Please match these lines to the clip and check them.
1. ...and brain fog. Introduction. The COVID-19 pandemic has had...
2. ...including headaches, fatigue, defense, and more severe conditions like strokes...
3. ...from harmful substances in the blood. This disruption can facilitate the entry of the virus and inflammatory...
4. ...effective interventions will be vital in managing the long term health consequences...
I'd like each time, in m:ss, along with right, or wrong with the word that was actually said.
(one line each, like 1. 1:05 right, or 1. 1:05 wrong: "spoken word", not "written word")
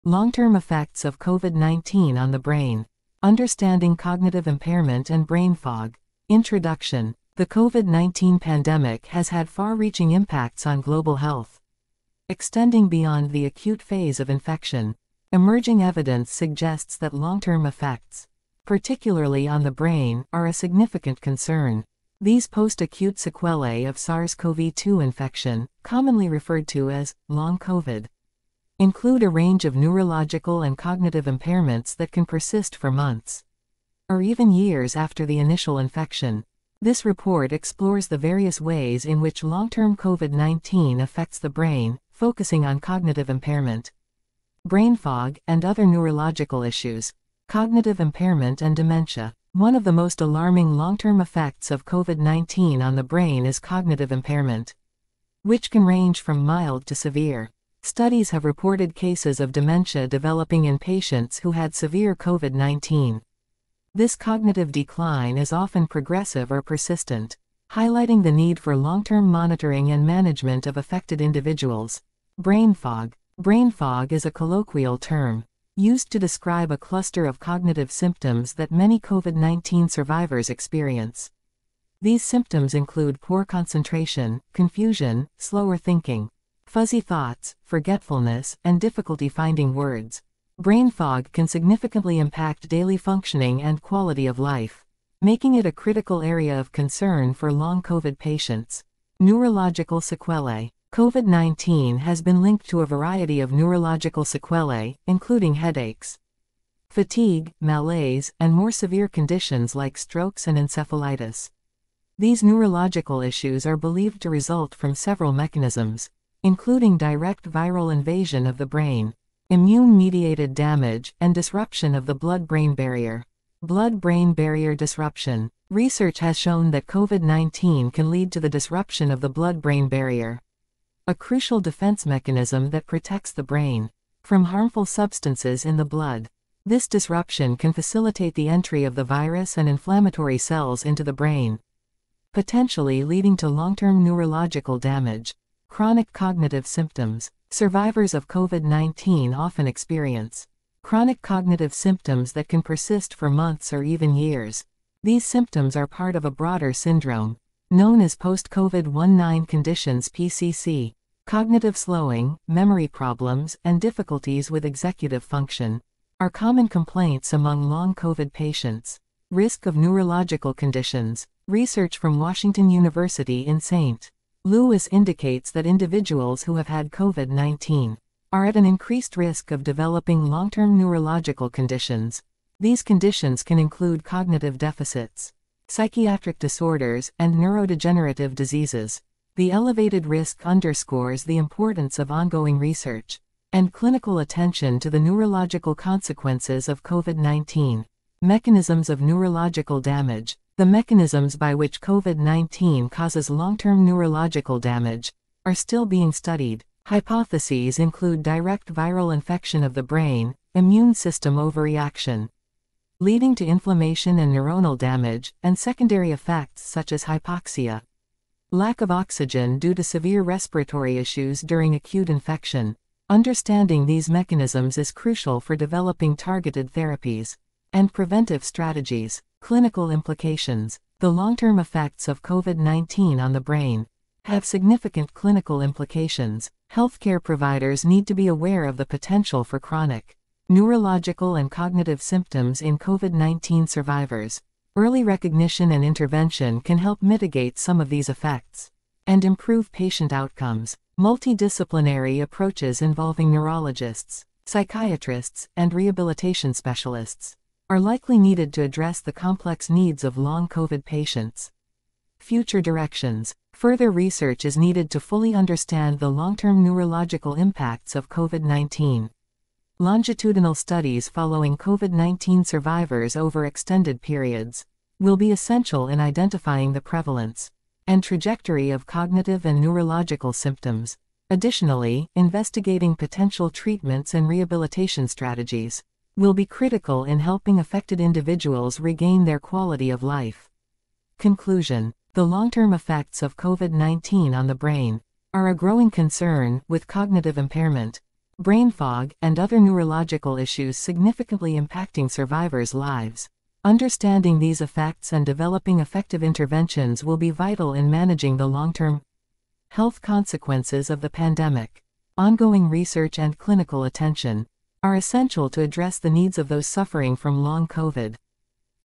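1. 0:05 right
2. 1:45 wrong: "malaise", not "defense"
3. 2:14 right
4. 5:05 right.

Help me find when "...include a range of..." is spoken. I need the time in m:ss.
0:28.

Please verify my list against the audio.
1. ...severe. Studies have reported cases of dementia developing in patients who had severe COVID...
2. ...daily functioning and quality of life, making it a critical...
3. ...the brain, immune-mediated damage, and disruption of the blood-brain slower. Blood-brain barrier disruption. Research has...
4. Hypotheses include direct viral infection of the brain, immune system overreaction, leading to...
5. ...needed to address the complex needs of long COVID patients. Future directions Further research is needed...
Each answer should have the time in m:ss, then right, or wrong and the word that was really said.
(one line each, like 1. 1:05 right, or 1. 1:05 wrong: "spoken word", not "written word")
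1. 0:56 right
2. 1:32 right
3. 1:58 wrong: "barrier", not "slower"
4. 3:26 right
5. 4:18 right.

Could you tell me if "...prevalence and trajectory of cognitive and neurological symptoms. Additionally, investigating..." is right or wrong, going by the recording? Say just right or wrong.
right.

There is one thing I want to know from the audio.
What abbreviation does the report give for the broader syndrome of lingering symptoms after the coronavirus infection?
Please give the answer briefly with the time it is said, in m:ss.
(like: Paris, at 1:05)
PCC, at 2:40.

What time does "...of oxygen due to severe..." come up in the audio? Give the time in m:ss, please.
3:38.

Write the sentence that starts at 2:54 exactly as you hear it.
Louis indicates that individuals who have had COVID 19 are at an increased risk of developing long term neurological conditions.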